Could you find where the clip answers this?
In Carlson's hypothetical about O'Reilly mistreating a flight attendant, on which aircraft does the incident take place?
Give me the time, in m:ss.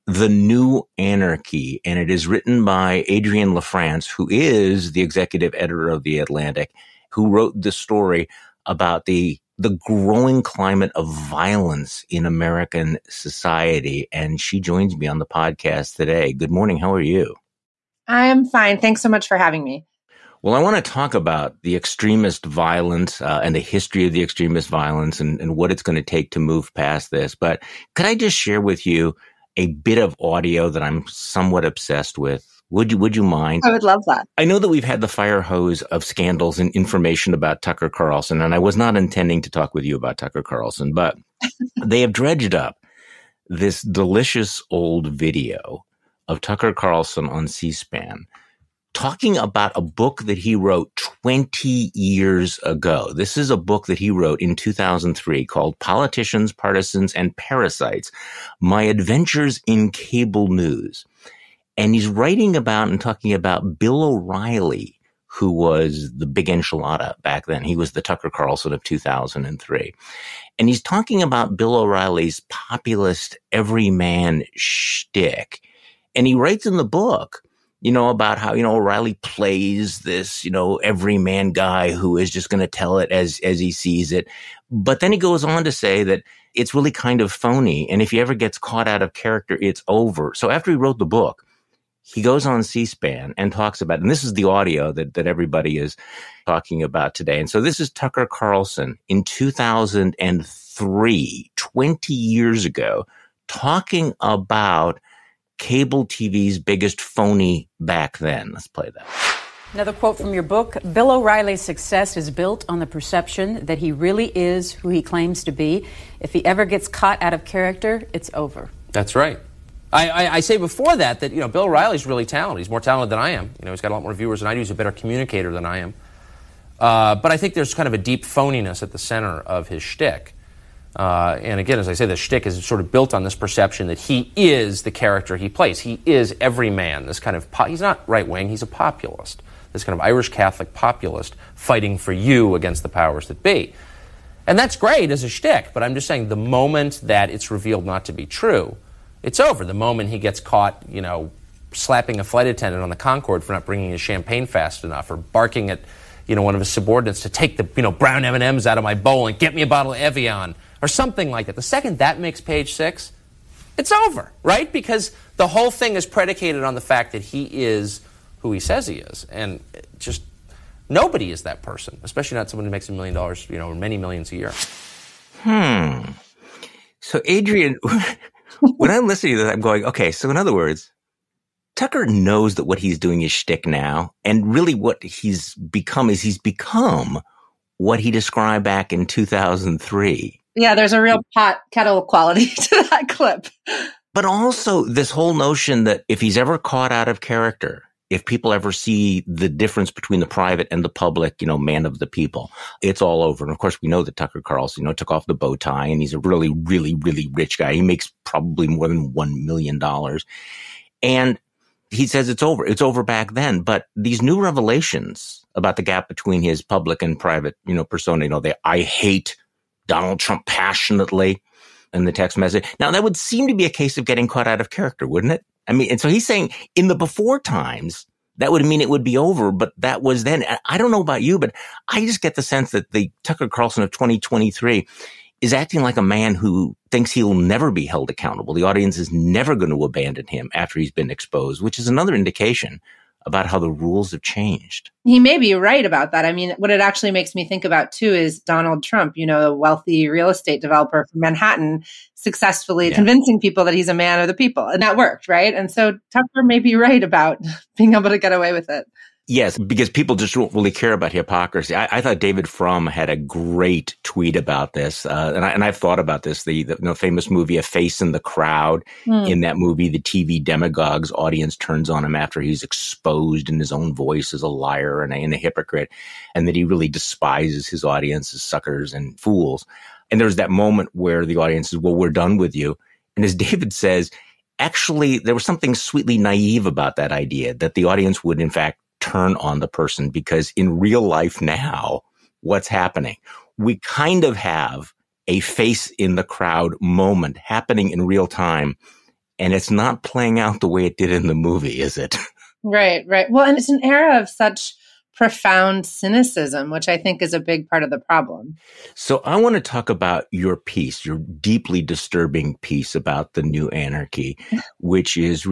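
2:32.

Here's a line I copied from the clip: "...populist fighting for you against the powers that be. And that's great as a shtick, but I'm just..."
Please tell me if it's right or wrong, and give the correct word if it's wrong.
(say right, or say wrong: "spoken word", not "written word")
right.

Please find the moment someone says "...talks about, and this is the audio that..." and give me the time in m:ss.
1:33.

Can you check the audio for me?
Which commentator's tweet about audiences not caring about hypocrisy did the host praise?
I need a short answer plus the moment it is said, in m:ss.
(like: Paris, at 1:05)
David Frum, at 4:22.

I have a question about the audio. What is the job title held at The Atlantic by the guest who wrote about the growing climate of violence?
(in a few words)
Executive editor.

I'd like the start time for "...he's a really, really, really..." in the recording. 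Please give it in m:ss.
3:26.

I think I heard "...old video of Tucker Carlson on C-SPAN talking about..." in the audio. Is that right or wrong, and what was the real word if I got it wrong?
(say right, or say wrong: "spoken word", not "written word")
right.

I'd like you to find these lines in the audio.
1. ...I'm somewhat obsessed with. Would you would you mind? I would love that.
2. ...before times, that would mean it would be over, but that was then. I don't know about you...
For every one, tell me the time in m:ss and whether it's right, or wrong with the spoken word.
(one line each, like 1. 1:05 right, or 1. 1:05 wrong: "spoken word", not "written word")
1. 0:30 right
2. 3:46 right.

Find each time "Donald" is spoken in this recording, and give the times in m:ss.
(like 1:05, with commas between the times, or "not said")
3:39, 4:08.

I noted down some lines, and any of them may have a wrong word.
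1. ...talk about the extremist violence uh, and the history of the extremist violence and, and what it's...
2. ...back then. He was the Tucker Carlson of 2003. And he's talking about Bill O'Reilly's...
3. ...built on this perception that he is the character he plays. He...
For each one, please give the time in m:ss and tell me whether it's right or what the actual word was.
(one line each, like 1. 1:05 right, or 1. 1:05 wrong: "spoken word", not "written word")
1. 0:20 right
2. 1:07 right
3. 2:12 right.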